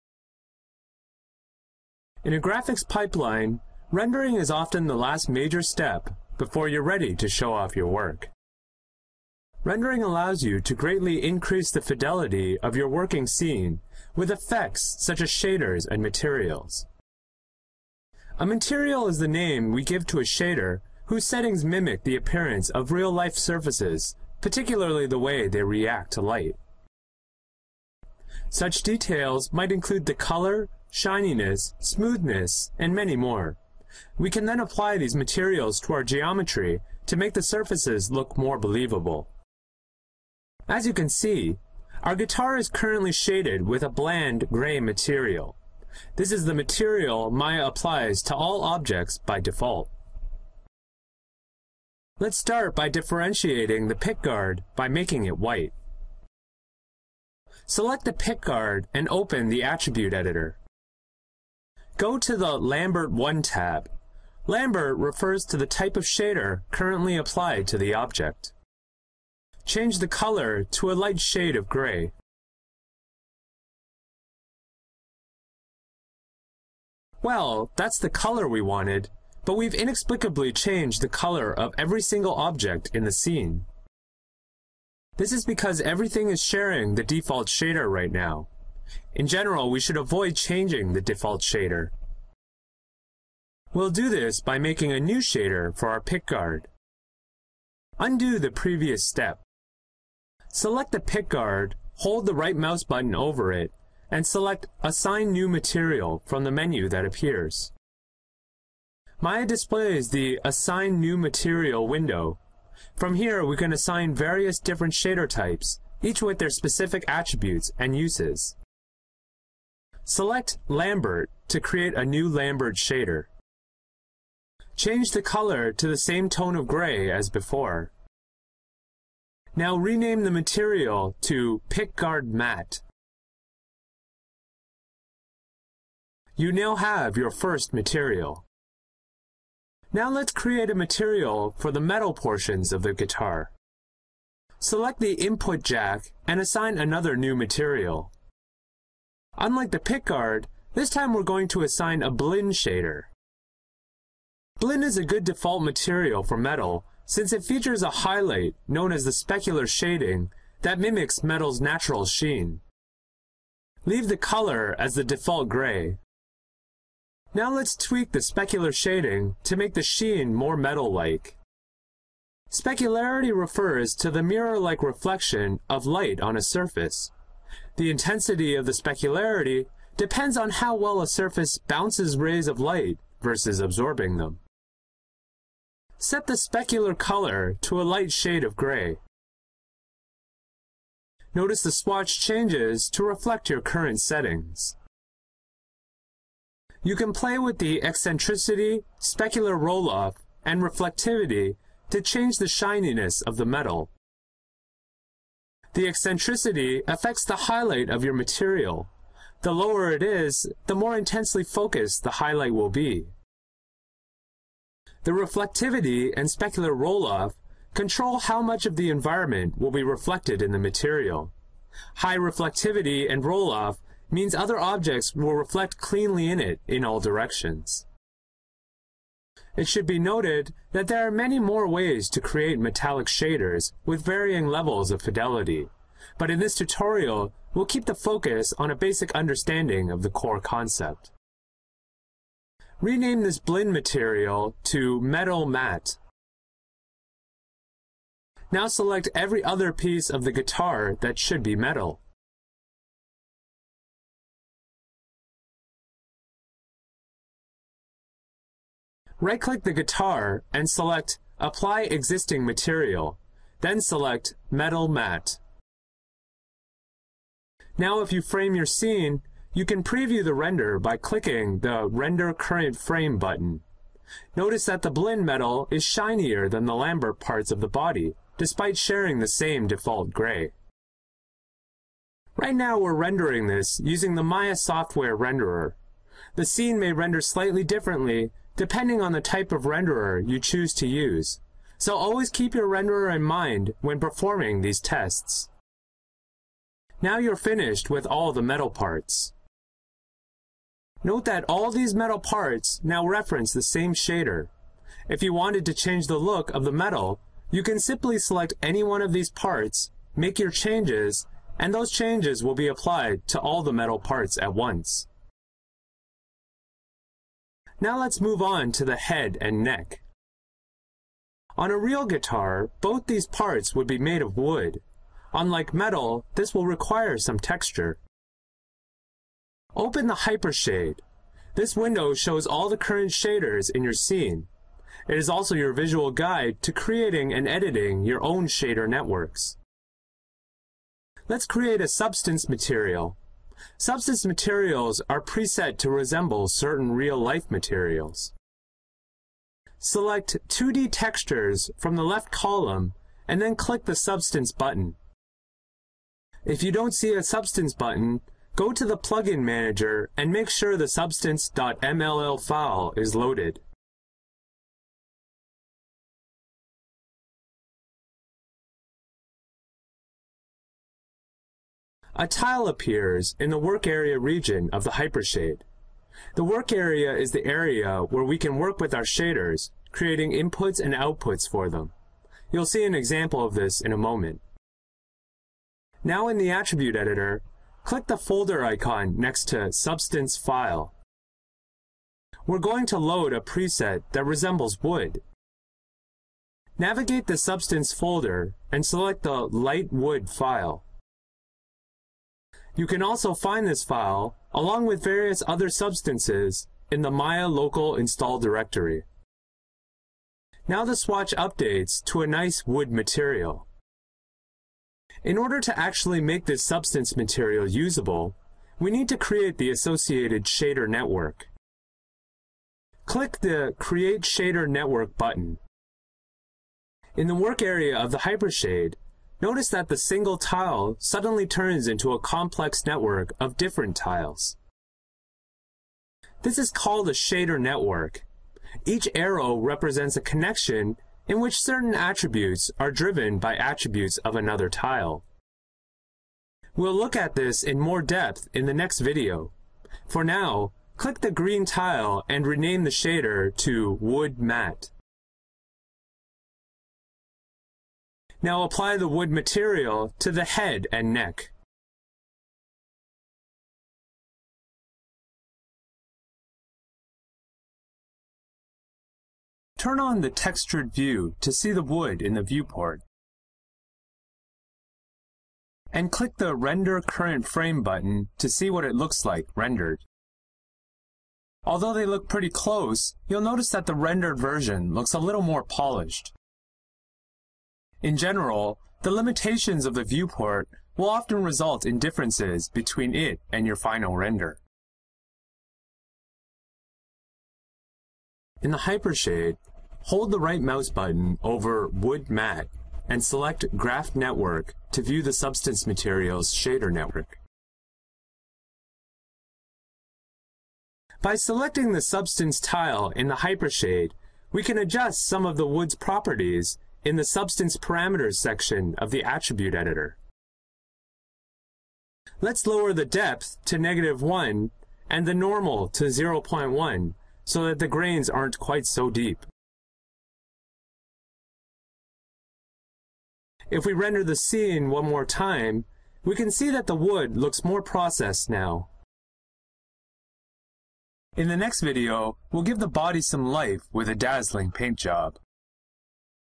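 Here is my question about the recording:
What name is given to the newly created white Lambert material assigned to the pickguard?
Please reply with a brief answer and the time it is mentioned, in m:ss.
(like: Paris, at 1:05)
PickGuard Matte, at 2:11.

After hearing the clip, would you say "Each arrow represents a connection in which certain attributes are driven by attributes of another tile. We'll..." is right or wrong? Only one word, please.
right.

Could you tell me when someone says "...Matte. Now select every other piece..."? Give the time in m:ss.
4:05.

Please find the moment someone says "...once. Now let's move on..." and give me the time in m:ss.
5:14.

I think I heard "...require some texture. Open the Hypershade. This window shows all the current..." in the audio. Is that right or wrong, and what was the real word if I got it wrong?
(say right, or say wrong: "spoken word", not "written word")
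right.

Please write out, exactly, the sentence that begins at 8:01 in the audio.
Although they look pretty close, you'll notice that the rendered version looks a little more polished.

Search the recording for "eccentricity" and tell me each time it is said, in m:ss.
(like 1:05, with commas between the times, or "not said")
3:17, 3:25.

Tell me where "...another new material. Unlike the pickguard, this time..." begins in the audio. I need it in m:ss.
2:26.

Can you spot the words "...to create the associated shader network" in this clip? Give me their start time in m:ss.
6:59.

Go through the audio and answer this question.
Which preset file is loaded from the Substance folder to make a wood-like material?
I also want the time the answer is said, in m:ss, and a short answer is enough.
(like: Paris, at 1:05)
Light Wood, at 6:39.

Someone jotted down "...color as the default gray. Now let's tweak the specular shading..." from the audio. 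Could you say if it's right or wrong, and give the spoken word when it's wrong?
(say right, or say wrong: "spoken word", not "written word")
right.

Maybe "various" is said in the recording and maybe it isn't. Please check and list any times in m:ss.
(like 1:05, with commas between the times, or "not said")
1:54, 6:45.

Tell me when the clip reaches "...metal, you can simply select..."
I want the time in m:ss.
5:06.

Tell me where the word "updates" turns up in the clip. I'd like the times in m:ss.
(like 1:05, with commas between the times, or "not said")
6:51.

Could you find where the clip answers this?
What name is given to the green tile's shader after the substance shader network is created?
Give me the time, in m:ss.
7:33.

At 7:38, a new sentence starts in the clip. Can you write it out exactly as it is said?
Now apply the wood material to the head and neck.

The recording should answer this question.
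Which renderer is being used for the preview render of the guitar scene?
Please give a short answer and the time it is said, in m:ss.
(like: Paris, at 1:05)
Maya software renderer, at 4:44.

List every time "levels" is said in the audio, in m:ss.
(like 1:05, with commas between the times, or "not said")
3:54.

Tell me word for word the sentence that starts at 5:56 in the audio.
If you don't see a Substance button, go to the Plugin Manager and make sure the substance.mll file is loaded.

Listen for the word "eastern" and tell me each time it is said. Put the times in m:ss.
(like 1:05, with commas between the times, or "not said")
not said.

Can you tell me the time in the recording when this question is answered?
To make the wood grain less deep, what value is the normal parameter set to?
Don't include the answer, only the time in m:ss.
8:46.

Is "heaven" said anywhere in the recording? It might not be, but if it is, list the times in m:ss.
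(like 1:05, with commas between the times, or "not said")
not said.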